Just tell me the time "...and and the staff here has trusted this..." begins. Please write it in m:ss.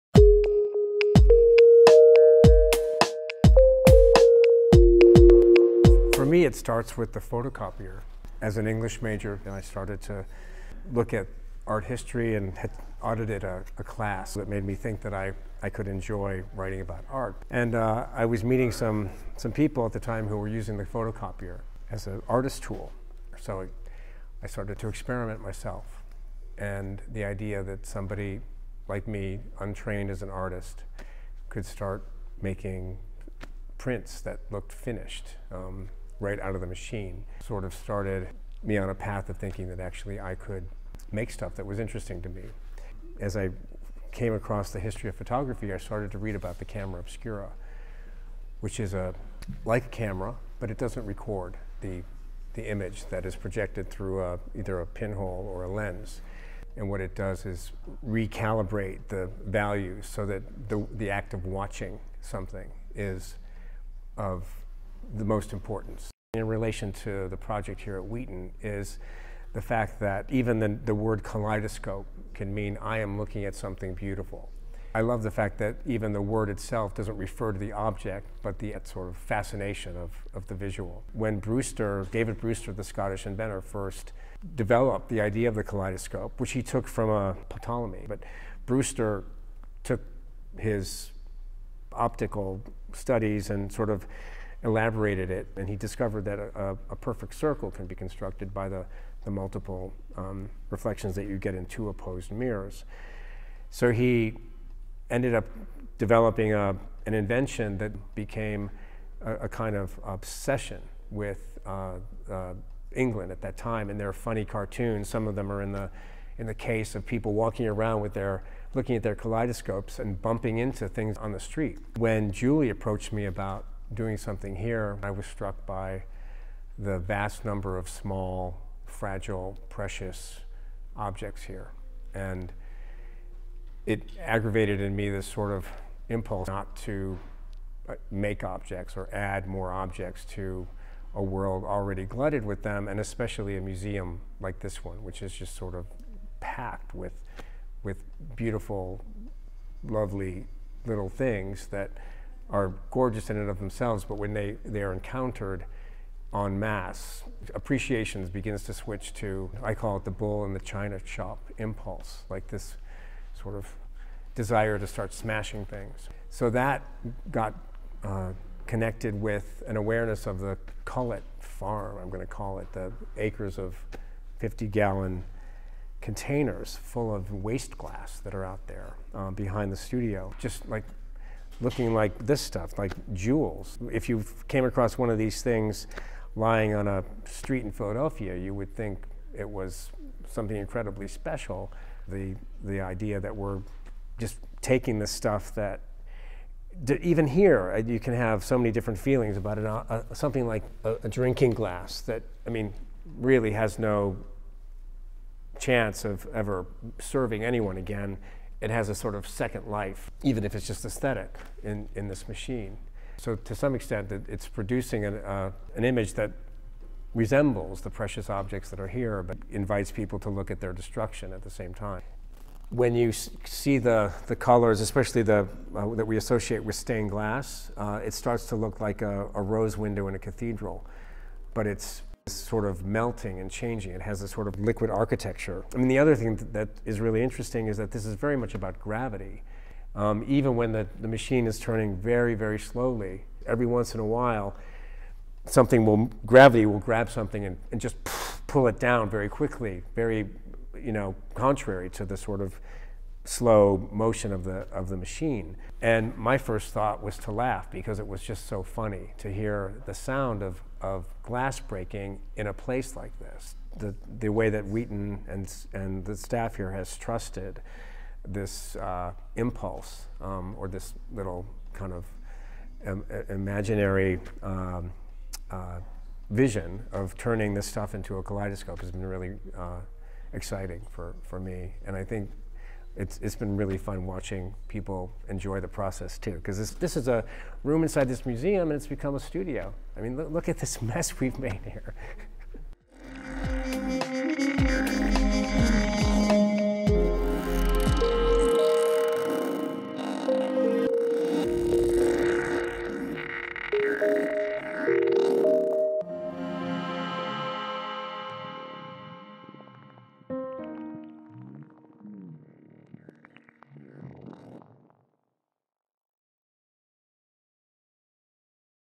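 4:25.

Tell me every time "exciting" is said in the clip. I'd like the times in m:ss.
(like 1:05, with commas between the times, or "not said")
4:40.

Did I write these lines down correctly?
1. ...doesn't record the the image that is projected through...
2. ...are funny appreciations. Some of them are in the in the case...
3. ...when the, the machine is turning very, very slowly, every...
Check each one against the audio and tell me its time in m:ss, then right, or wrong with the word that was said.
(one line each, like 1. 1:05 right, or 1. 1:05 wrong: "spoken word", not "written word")
1. 0:50 right
2. 1:54 wrong: "cartoons", not "appreciations"
3. 4:00 right.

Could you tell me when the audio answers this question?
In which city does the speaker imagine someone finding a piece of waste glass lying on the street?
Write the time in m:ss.
3:07.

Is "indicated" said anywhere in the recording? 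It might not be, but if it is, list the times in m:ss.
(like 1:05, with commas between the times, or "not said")
not said.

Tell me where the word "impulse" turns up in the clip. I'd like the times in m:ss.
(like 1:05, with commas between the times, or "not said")
2:16, 2:41, 4:29.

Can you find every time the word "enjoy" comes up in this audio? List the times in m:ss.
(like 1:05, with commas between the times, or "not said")
0:15, 4:45.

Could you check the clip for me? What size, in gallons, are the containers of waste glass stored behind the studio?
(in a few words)
50.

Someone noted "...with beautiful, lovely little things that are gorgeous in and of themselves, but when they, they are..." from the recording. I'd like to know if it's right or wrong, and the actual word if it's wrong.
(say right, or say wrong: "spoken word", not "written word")
right.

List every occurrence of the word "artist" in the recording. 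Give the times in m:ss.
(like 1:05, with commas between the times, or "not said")
0:22, 0:30.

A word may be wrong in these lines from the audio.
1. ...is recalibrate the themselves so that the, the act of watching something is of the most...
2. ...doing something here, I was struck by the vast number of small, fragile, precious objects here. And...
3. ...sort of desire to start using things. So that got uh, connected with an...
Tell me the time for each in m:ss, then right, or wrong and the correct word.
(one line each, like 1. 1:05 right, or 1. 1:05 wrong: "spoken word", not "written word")
1. 0:57 wrong: "values", not "themselves"
2. 2:03 right
3. 2:43 wrong: "smashing", not "using".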